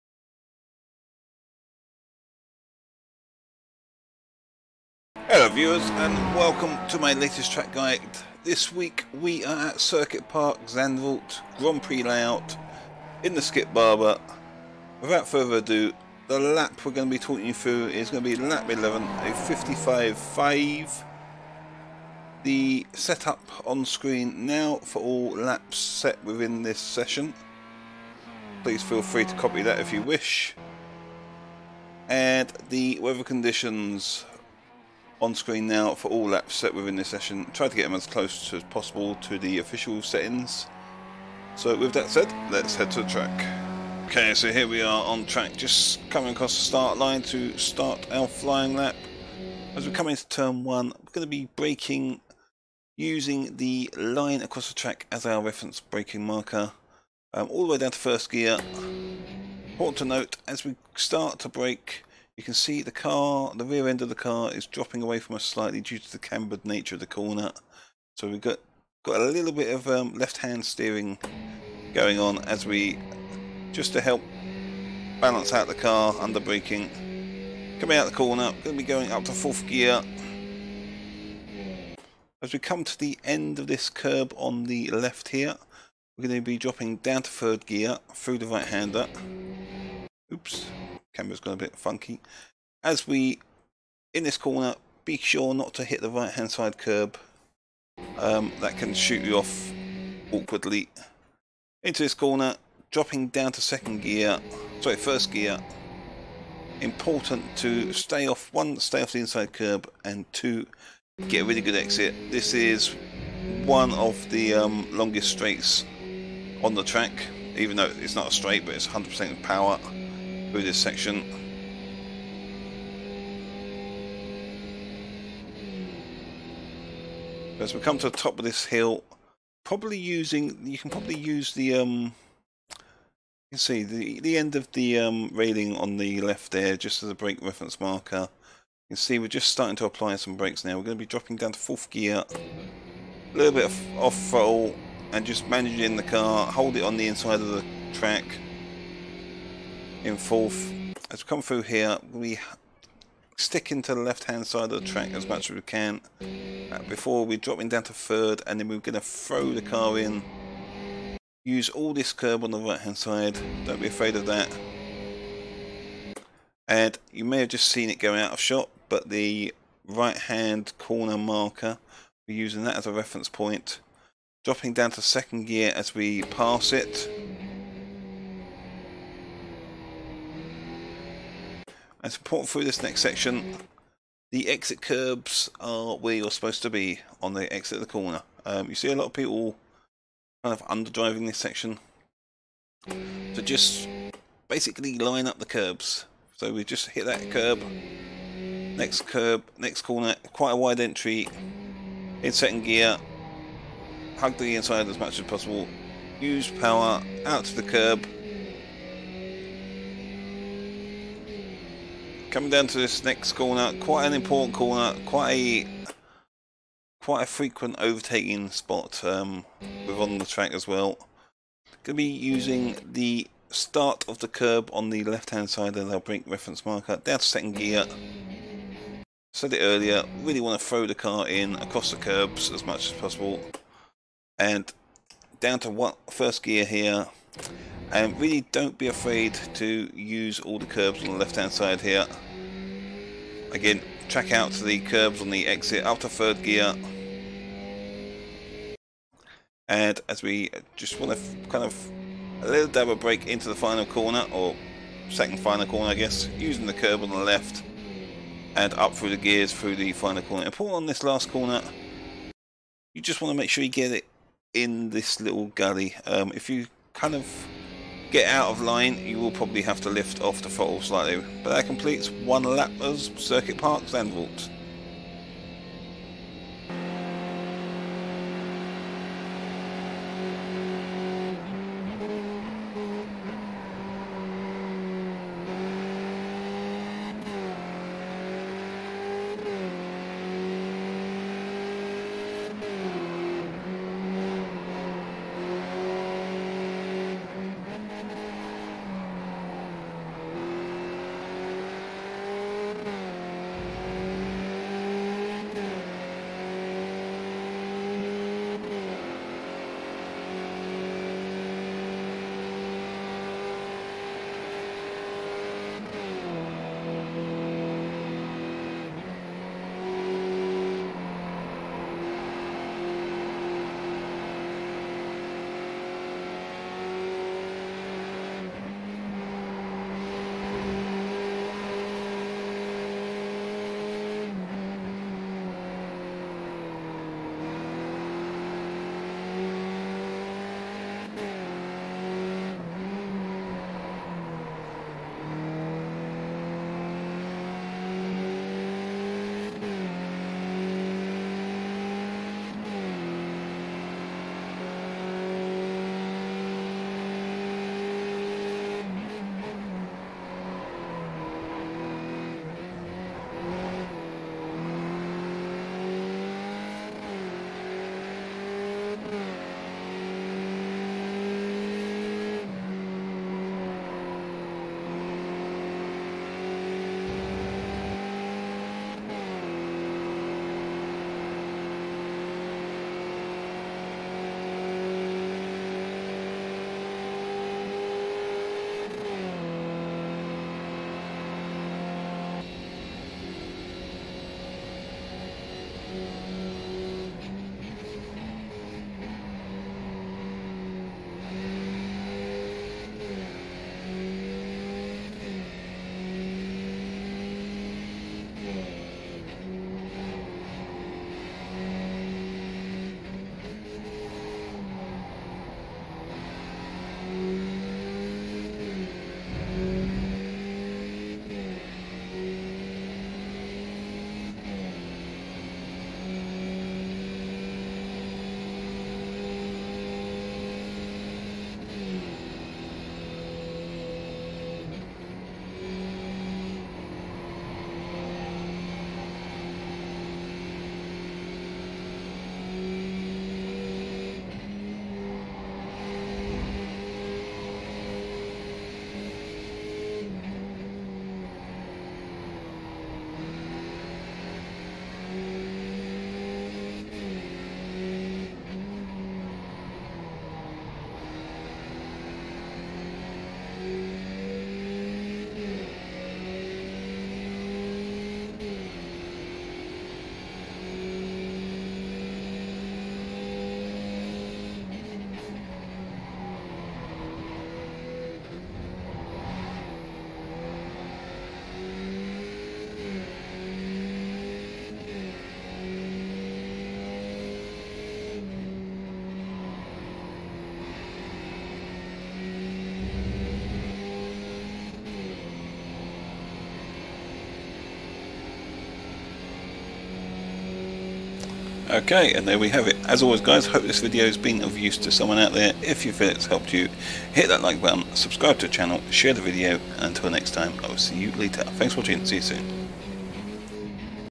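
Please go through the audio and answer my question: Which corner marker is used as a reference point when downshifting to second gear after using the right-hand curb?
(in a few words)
right-hand corner marker.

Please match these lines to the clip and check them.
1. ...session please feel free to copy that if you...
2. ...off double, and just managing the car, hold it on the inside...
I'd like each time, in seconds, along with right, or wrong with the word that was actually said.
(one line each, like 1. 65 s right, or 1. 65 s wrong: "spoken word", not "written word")
1. 26 s right
2. 143 s wrong: "throttle", not "double".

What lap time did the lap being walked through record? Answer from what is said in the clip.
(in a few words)
55.5.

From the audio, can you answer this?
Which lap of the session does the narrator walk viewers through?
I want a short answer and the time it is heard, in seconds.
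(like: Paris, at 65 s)
11, at 18 s.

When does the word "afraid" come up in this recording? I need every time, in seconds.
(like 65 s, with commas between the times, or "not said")
163 s, 238 s.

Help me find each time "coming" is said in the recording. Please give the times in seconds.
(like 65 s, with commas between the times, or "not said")
46 s, 77 s, 212 s.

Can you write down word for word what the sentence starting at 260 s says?
Important on this last corner, you just want to make sure you get it in this little gully.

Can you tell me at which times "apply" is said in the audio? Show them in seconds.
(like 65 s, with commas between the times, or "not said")
139 s.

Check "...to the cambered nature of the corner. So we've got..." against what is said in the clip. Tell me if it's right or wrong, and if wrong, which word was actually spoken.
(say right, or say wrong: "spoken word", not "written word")
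right.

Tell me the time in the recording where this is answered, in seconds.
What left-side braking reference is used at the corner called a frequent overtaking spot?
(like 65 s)
223 s.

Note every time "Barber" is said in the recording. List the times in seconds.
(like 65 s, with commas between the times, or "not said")
13 s.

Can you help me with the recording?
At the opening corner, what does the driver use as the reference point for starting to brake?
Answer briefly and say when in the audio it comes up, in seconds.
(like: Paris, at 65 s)
the line across the track, at 53 s.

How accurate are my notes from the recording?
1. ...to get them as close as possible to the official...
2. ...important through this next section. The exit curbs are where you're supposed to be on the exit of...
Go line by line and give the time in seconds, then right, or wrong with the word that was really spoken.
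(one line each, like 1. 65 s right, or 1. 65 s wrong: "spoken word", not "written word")
1. 37 s right
2. 182 s right.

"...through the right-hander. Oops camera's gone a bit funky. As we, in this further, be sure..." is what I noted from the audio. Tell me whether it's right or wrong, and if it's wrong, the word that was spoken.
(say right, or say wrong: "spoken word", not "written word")
wrong: "corner", not "further".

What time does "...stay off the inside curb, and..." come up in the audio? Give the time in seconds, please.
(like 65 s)
108 s.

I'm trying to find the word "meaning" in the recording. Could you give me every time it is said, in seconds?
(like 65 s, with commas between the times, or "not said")
not said.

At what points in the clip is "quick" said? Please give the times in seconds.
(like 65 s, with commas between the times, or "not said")
not said.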